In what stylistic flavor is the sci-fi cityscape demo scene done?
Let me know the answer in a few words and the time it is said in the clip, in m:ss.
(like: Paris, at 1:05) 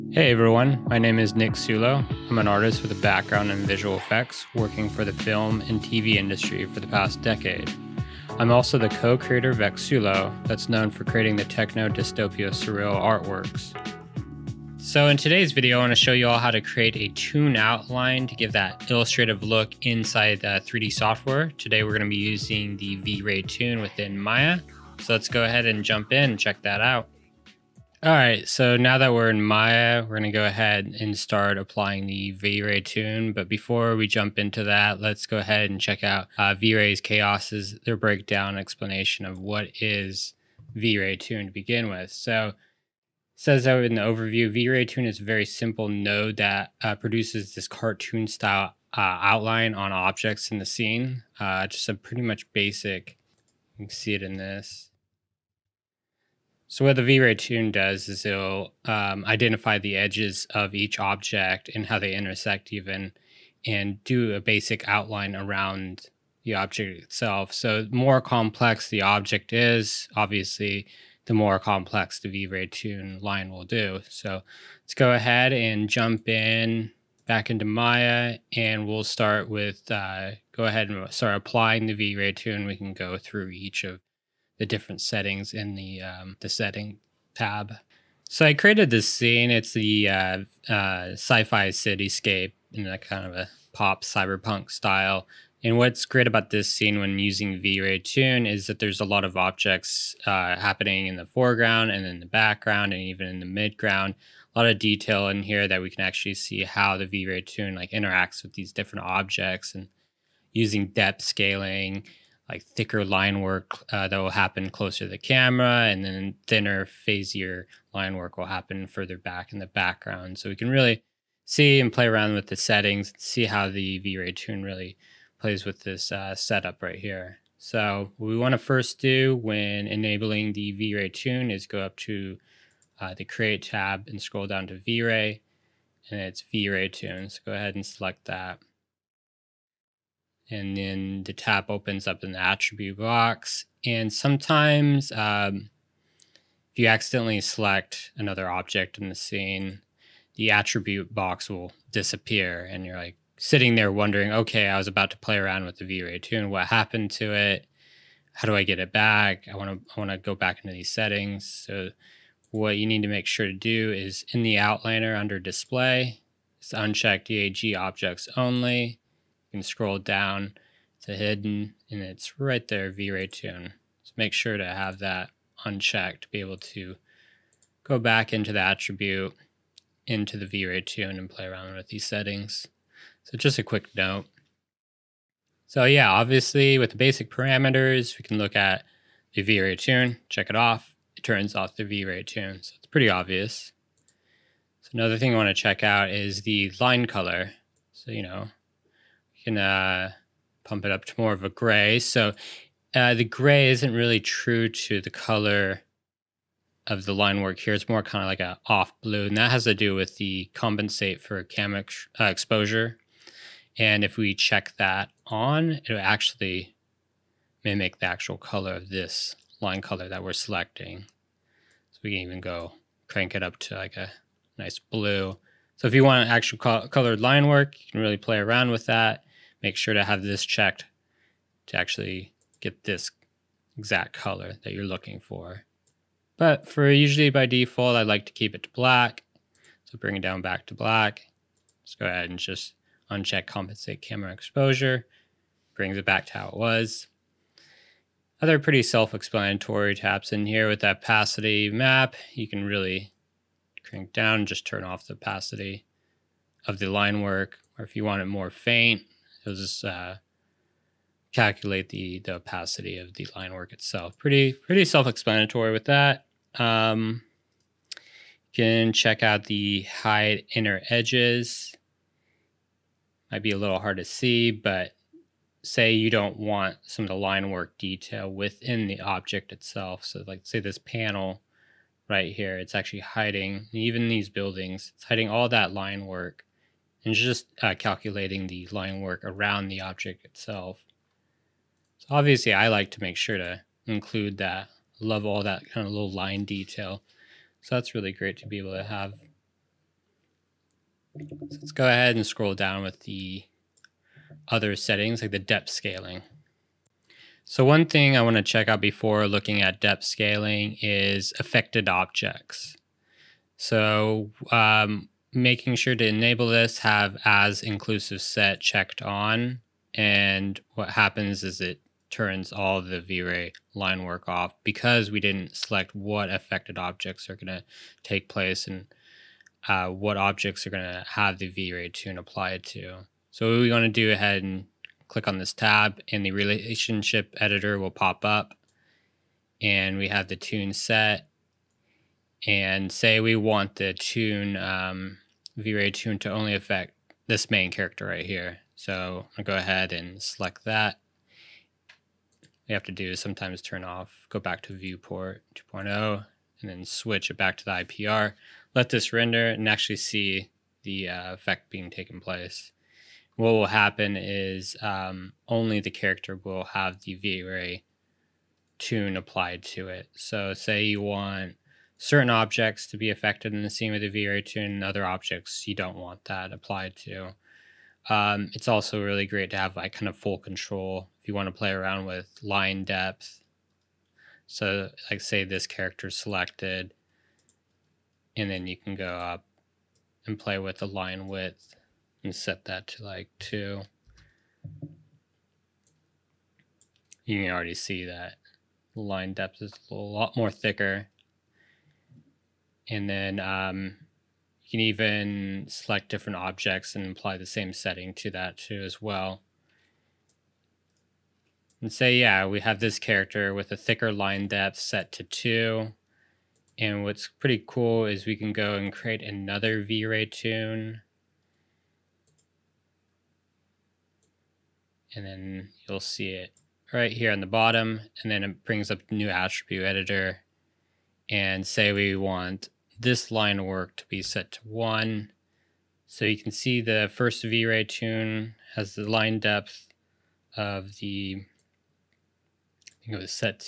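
pop cyberpunk, at 1:33.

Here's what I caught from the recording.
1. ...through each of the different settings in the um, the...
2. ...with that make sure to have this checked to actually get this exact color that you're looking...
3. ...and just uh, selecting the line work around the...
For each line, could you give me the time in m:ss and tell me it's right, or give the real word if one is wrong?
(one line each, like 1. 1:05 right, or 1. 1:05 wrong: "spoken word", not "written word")
1. 1:23 right
2. 3:48 right
3. 4:47 wrong: "calculating", not "selecting".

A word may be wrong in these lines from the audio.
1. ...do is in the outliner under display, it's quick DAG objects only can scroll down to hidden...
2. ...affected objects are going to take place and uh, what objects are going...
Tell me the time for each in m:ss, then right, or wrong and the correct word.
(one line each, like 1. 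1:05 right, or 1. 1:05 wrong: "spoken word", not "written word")
1. 2:43 wrong: "uncheck", not "quick"
2. 5:26 right.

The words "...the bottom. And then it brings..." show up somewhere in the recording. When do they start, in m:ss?
7:07.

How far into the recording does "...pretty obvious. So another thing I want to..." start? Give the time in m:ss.
3:12.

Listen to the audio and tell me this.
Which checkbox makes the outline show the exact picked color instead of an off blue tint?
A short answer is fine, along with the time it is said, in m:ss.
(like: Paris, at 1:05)
compensate camera exposure, at 4:03.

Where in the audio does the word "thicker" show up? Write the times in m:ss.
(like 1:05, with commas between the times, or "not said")
1:52, 6:40, 6:53.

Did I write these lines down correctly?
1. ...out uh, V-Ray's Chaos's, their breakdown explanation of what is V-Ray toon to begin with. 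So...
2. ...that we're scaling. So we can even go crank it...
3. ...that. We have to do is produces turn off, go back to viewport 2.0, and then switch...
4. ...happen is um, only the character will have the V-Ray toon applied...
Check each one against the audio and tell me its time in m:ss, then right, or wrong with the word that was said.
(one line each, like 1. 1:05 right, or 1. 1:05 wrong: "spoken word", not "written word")
1. 0:36 right
2. 3:40 wrong: "selecting", not "scaling"
3. 5:50 wrong: "sometimes", not "produces"
4. 6:03 right.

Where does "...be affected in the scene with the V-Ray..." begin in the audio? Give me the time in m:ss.
6:12.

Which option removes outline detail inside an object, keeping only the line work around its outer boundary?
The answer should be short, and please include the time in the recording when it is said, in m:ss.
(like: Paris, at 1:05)
hide inner edges, at 4:29.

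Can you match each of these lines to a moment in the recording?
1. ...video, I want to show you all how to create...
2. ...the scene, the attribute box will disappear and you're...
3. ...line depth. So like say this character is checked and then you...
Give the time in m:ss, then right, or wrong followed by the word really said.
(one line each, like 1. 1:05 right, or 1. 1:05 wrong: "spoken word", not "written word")
1. 0:15 right
2. 2:29 right
3. 6:22 wrong: "selected", not "checked".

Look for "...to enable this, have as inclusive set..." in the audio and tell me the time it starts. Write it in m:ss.
5:15.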